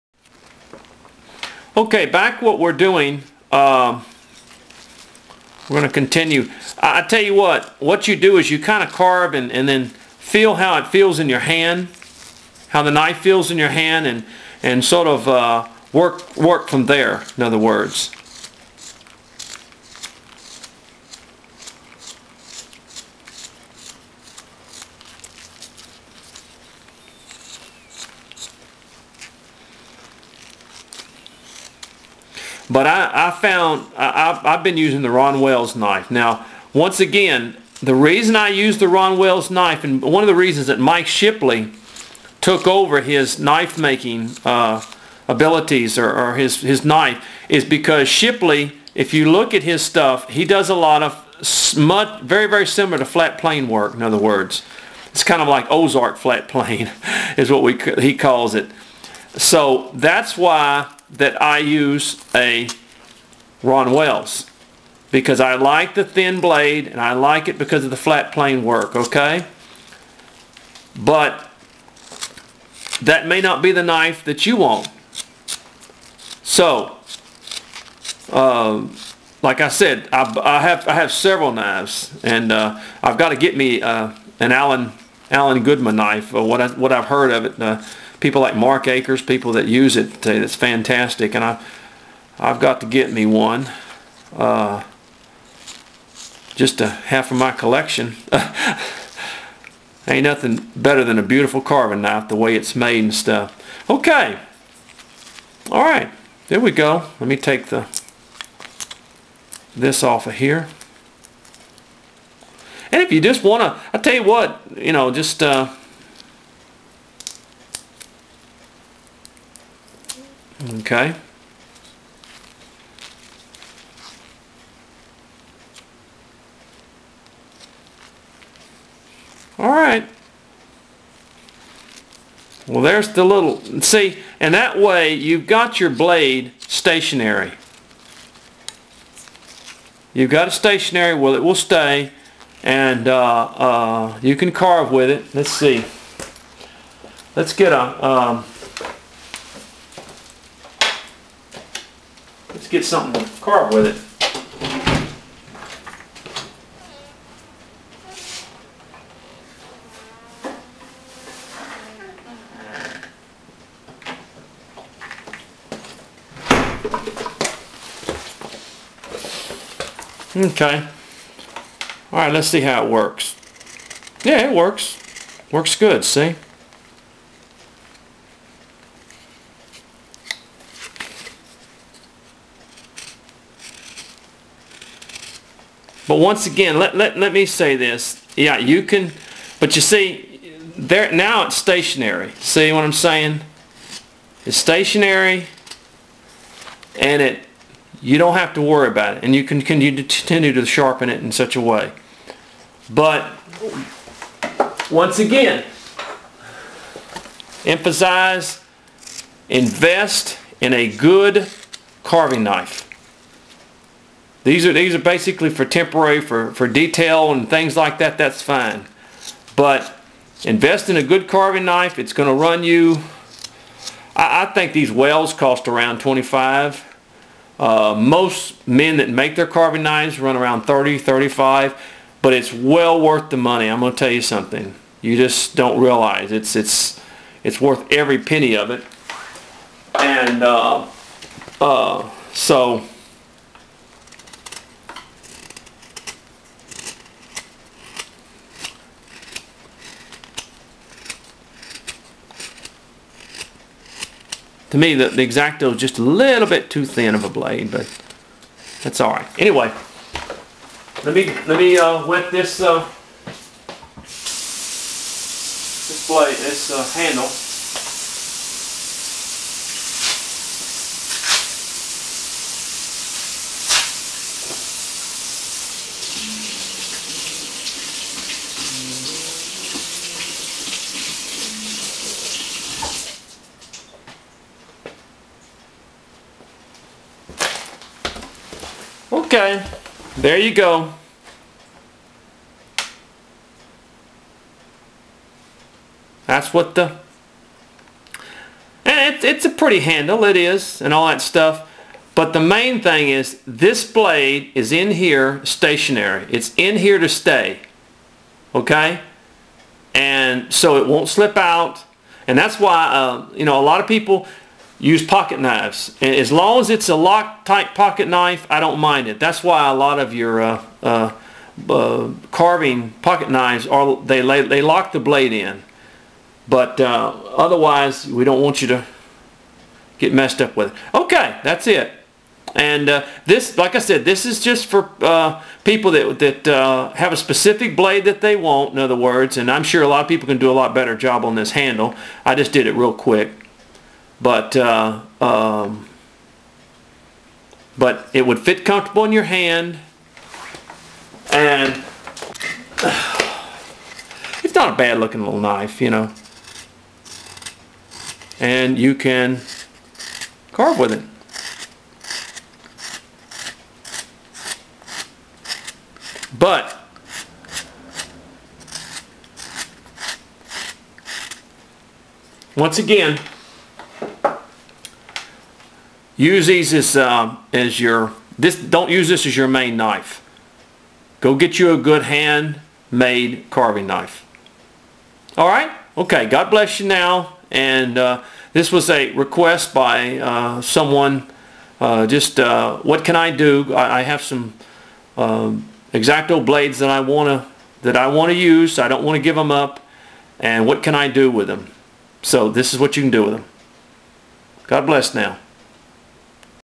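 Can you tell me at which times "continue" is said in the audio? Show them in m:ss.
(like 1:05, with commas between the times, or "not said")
0:05, 3:19.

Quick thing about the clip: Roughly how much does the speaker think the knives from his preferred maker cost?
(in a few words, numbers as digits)
25.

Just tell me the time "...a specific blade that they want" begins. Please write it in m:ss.
5:37.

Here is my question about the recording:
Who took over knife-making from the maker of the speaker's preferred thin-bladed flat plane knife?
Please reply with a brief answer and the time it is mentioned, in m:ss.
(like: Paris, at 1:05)
Mike Shipley, at 0:40.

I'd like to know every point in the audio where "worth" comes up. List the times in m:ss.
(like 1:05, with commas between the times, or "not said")
3:52, 3:57.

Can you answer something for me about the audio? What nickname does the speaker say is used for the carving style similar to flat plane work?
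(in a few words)
Ozark flat plane.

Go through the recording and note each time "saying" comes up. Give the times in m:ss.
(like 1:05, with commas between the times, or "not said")
3:12.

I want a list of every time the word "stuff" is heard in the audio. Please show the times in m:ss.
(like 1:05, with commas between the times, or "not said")
0:49, 1:43, 5:01.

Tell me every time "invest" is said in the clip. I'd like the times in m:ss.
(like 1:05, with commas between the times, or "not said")
3:29, 3:40.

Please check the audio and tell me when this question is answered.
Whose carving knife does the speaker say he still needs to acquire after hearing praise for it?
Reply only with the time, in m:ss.
1:25.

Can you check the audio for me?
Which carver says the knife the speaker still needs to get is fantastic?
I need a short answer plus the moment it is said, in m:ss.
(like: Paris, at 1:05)
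Mark Akers, at 1:28.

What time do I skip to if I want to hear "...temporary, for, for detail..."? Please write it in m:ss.
3:35.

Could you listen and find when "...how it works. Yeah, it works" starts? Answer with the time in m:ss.
2:52.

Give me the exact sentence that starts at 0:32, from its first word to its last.
But I, I found I, I've been using the Ron Wells knife.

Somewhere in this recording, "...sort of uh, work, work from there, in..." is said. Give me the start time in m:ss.
0:14.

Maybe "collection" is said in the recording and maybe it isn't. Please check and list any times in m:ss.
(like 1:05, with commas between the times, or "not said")
1:37.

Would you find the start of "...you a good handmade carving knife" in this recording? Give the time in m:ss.
6:21.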